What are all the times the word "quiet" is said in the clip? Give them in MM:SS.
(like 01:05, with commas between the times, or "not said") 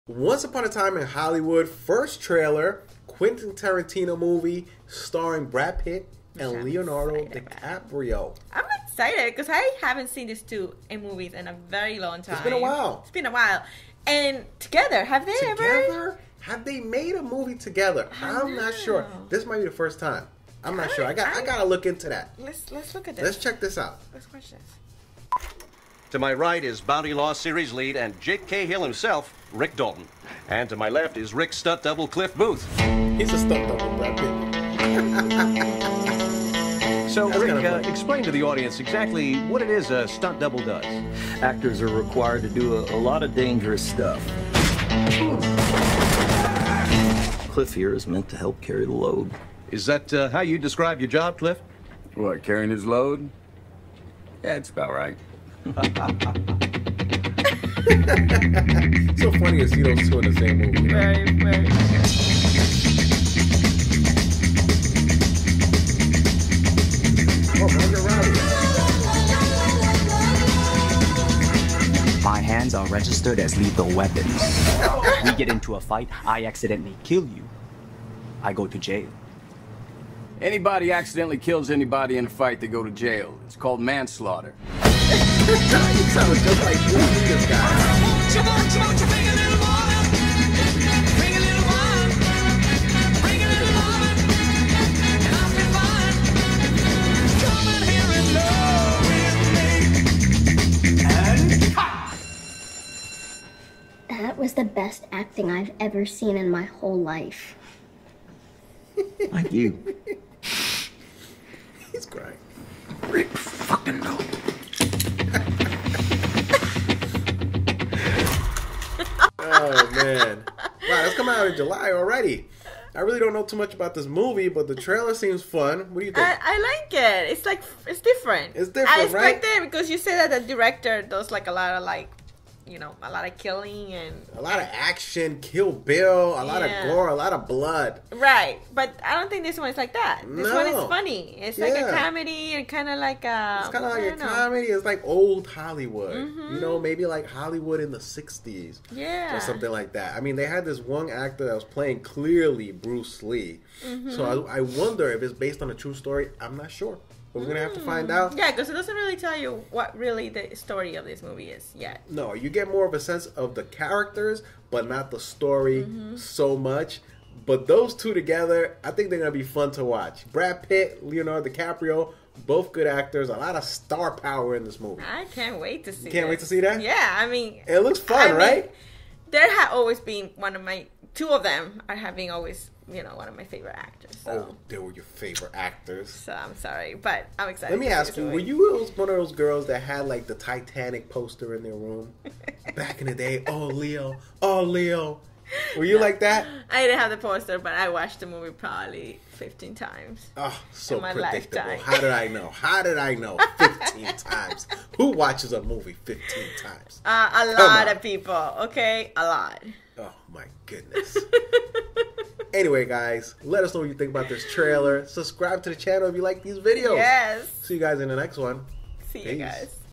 not said.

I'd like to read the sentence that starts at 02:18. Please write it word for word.
Right, but I don't think this one is like that.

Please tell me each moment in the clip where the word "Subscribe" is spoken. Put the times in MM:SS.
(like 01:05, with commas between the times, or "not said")
03:35.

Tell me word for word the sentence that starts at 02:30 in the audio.
I mean, they had this one actor that was playing clearly Bruce Lee.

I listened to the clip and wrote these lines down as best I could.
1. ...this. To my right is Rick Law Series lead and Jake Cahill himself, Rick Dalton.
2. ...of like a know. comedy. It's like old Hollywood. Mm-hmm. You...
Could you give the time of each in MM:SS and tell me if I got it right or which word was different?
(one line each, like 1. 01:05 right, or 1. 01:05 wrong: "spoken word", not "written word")
1. 00:24 wrong: "Bounty", not "Rick"
2. 02:23 right.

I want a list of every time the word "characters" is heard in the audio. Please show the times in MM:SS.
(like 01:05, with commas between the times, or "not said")
02:43.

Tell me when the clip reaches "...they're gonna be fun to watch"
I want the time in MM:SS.
02:49.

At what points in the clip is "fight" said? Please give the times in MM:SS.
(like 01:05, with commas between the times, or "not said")
01:15, 01:22.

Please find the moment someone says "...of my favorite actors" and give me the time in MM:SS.
03:03.